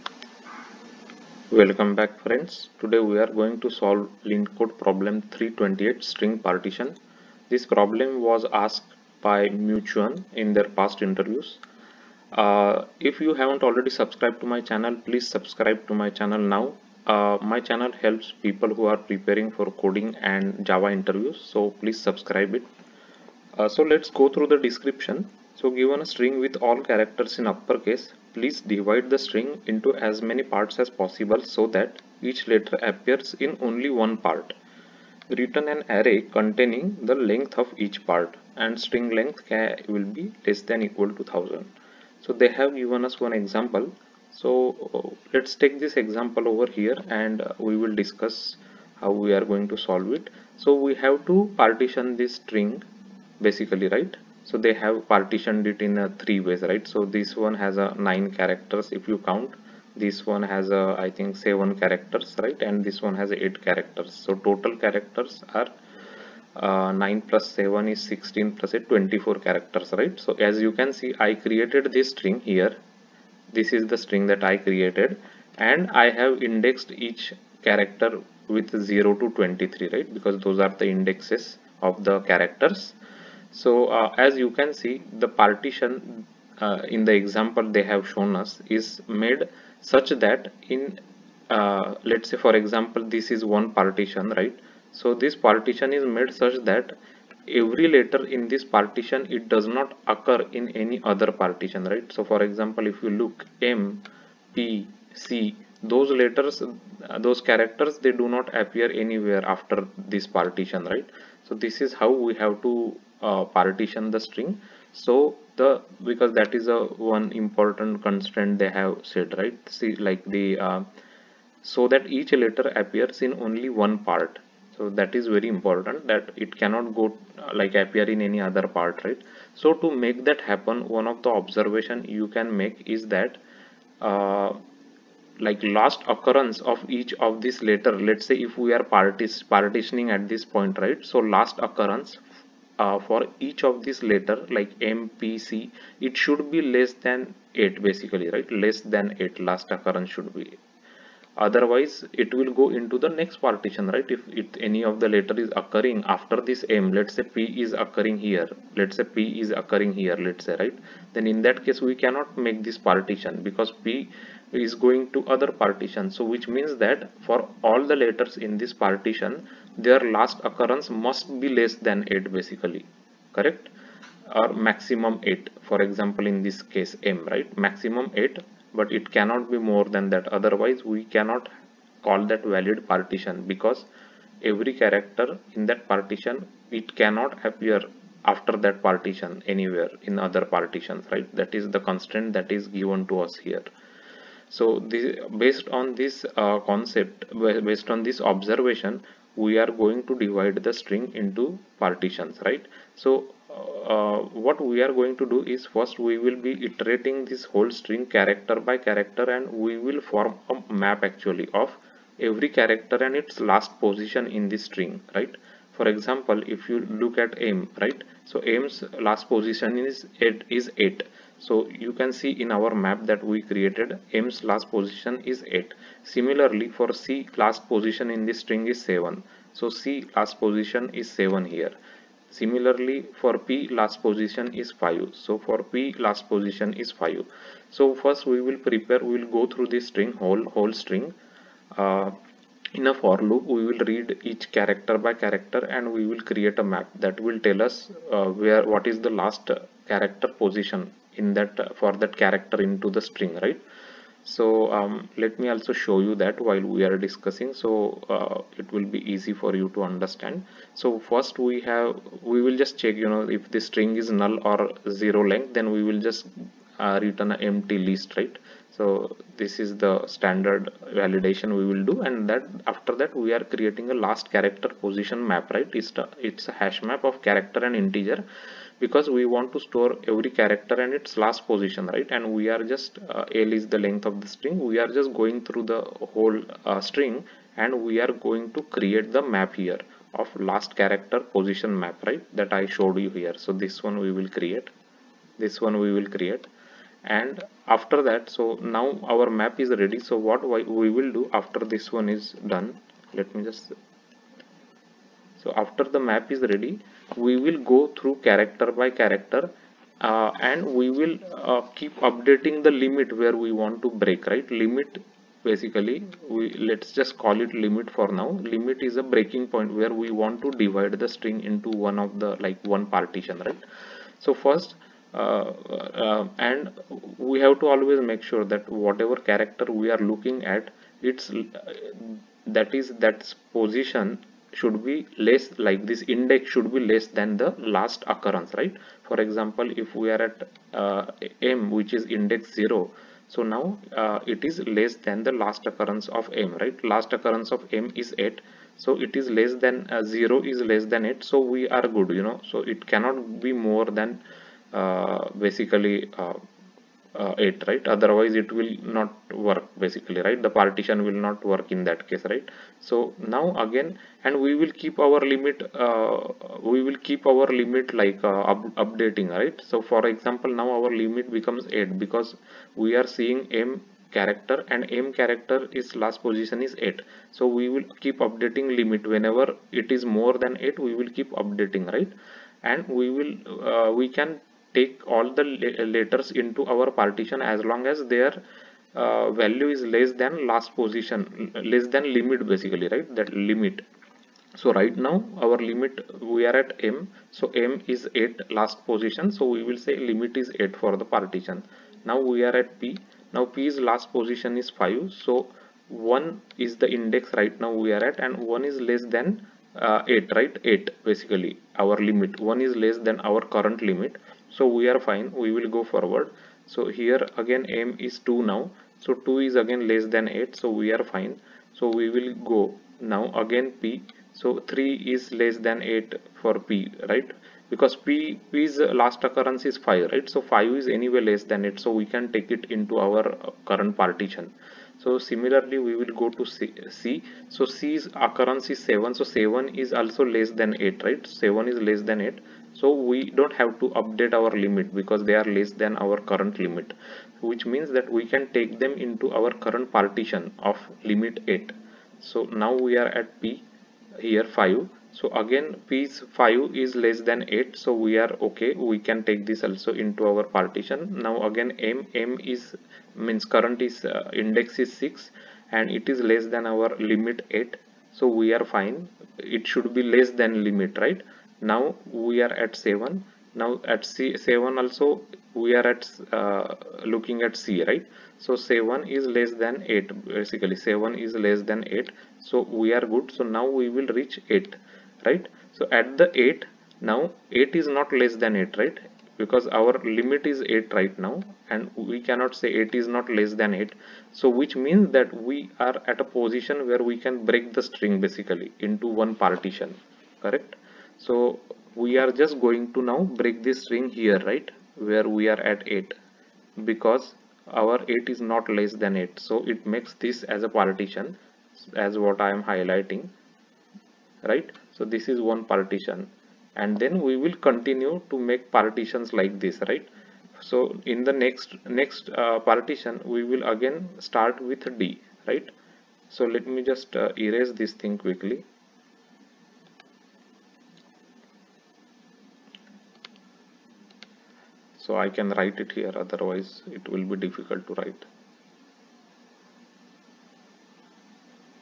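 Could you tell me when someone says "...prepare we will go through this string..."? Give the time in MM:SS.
03:58.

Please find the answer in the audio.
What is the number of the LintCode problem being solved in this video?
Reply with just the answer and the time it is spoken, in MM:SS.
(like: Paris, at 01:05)
328, at 00:05.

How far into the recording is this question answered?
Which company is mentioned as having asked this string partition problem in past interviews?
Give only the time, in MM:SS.
00:09.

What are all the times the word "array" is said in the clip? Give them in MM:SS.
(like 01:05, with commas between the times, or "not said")
00:35.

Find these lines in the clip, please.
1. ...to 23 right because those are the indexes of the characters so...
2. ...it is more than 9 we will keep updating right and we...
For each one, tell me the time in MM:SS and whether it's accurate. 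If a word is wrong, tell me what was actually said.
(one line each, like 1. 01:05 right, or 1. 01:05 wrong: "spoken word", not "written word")
1. 01:19 right
2. 06:19 wrong: "8", not "9".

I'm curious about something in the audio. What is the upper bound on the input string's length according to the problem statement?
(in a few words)
1000.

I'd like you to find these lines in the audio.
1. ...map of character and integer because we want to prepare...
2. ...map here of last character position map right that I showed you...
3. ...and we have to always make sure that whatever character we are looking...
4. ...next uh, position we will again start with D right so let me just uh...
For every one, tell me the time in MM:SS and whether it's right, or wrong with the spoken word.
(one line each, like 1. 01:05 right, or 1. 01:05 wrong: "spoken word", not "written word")
1. 04:36 wrong: "store", not "prepare"
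2. 04:49 right
3. 05:26 right
4. 08:41 wrong: "partition", not "position".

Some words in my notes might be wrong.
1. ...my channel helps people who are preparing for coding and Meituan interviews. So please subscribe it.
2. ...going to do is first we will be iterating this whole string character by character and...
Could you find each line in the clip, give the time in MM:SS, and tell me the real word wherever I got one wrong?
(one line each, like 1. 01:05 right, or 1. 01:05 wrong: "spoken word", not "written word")
1. 00:17 wrong: "Java", not "Meituan"
2. 03:24 right.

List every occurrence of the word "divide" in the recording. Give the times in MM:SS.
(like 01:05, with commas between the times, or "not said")
00:28, 03:20, 05:20.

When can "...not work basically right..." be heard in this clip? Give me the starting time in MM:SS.
05:58.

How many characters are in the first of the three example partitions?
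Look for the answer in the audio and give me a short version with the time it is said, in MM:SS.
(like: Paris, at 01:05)
nine, at 00:58.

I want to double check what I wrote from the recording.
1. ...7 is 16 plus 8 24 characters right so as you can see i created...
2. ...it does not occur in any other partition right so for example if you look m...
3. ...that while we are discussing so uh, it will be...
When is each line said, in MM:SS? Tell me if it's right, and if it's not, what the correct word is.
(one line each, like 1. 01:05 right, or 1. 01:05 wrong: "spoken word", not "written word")
1. 01:07 right
2. 01:39 right
3. 04:16 right.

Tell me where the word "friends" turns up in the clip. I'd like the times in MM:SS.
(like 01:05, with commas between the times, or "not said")
00:02.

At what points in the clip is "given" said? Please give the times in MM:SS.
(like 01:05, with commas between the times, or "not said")
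00:25, 00:42, 03:12.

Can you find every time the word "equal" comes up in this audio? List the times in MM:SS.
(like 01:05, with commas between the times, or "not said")
00:40.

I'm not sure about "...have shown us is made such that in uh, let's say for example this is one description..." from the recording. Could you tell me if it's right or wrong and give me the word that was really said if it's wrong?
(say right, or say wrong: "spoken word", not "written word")
wrong: "partition", not "description".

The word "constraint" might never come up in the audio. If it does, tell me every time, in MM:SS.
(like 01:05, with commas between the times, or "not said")
01:58, 03:11.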